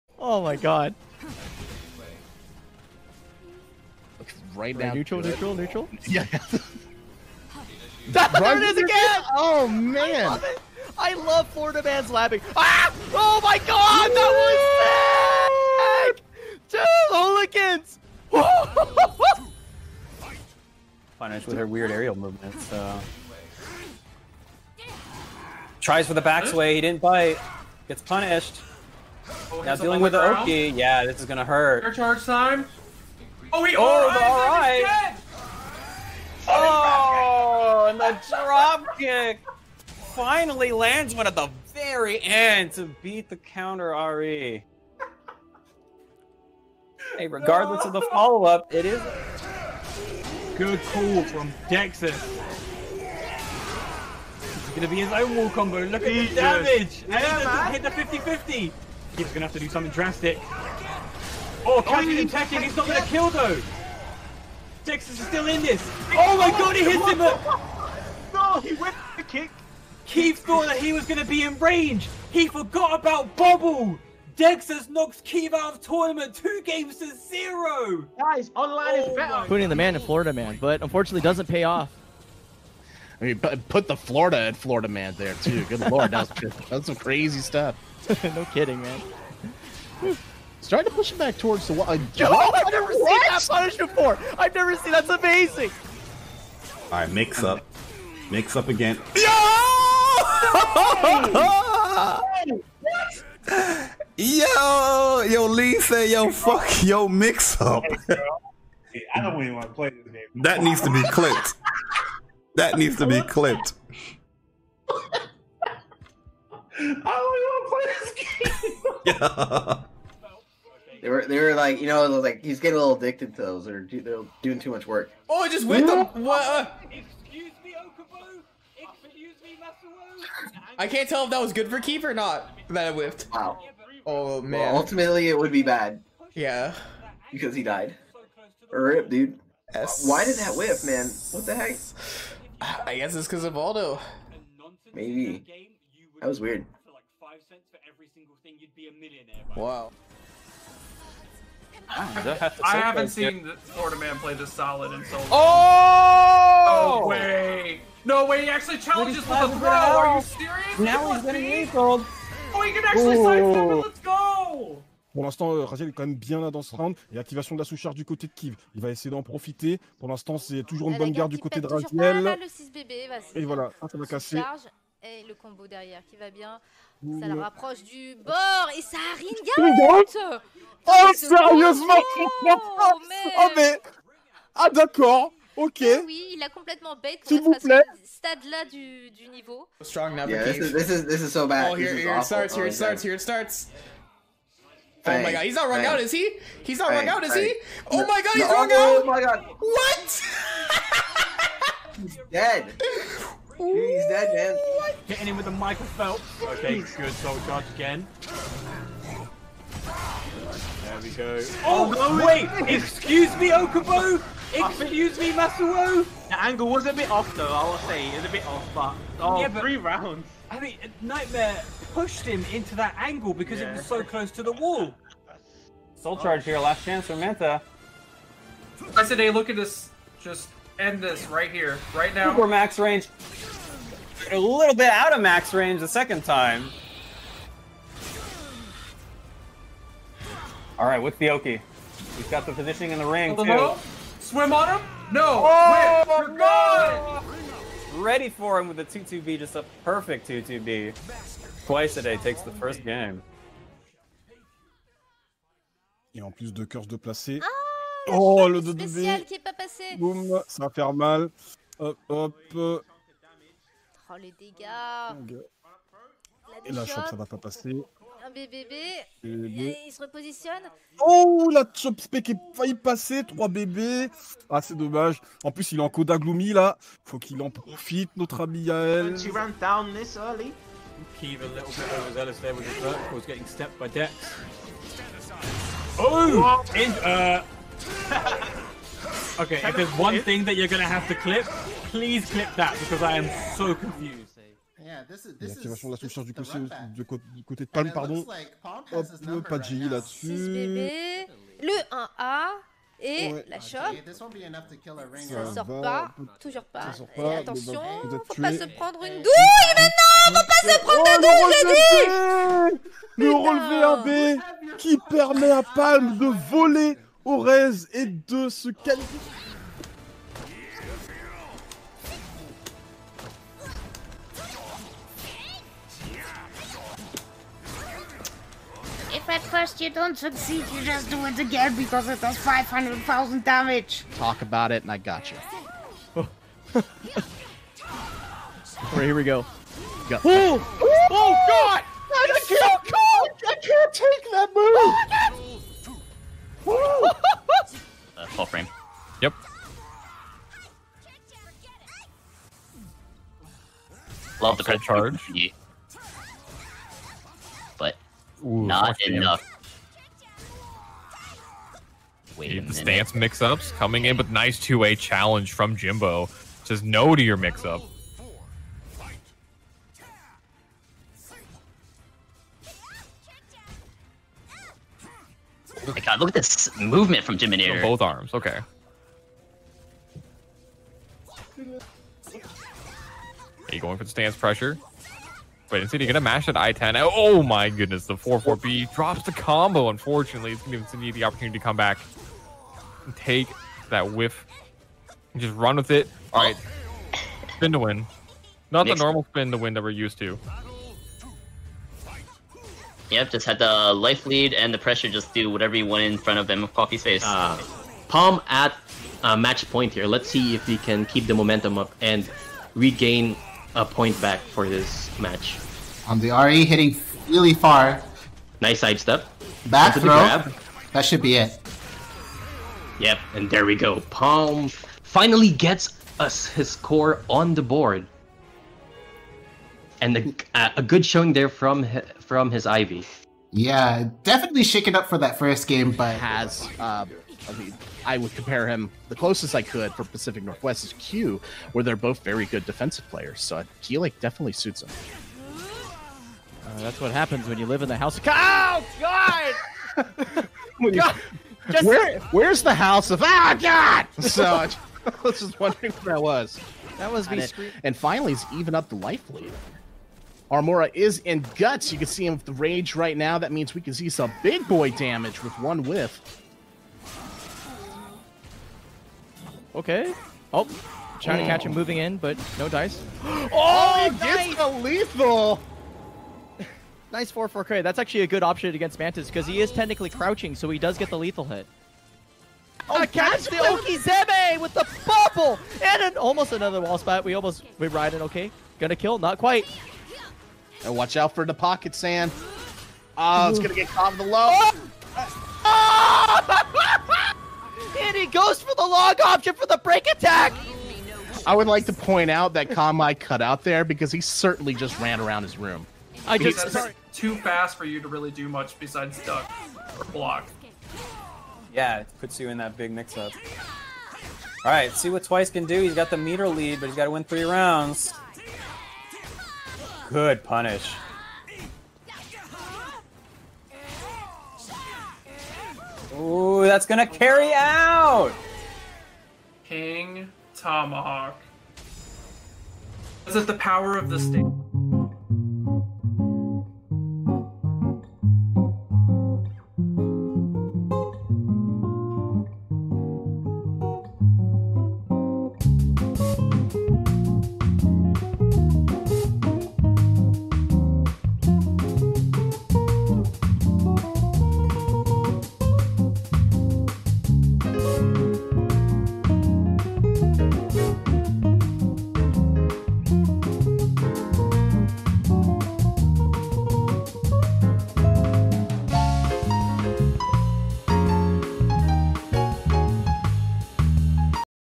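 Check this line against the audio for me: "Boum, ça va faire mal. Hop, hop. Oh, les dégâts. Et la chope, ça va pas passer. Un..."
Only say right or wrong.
right.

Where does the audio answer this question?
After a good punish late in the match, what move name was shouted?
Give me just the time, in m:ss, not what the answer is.
8:49.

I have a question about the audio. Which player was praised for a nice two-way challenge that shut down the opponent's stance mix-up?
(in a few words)
Jimbo.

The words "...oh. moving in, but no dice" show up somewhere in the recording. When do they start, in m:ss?
7:51.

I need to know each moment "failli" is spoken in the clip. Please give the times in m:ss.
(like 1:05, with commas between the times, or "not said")
4:32.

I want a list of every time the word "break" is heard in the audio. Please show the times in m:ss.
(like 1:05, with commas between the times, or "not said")
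8:19.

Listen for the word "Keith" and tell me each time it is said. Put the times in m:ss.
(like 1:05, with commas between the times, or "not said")
0:59, 1:10, 1:15.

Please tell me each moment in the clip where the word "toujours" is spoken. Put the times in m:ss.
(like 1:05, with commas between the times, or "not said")
2:50, 5:06.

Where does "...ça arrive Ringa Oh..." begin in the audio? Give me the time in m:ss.
2:58.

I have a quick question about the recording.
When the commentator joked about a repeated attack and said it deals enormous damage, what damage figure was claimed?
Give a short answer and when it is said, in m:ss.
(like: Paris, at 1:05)
500,000, at 5:32.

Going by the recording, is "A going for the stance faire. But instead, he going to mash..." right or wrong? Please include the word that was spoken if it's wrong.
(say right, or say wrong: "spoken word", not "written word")
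wrong: "pressure", not "faire".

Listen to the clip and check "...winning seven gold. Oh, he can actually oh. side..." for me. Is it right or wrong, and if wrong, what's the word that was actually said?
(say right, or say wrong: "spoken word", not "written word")
wrong: "eight", not "seven".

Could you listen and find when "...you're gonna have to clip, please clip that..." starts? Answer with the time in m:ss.
4:50.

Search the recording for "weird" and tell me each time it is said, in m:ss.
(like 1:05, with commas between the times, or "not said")
0:21, 2:26.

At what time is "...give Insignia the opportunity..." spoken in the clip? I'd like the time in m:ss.
6:30.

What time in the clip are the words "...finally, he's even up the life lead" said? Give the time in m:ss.
7:37.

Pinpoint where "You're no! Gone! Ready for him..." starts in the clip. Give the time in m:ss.
4:06.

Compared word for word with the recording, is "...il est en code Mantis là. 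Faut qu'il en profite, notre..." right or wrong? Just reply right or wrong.
wrong.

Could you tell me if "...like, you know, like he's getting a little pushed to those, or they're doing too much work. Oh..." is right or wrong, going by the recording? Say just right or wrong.
wrong.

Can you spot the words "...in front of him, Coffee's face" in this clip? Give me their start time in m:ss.
6:46.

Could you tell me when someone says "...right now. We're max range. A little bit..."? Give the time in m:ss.
3:51.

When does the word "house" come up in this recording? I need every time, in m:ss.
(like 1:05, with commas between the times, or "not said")
7:27, 7:32.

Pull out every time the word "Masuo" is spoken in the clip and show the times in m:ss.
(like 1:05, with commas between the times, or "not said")
3:35.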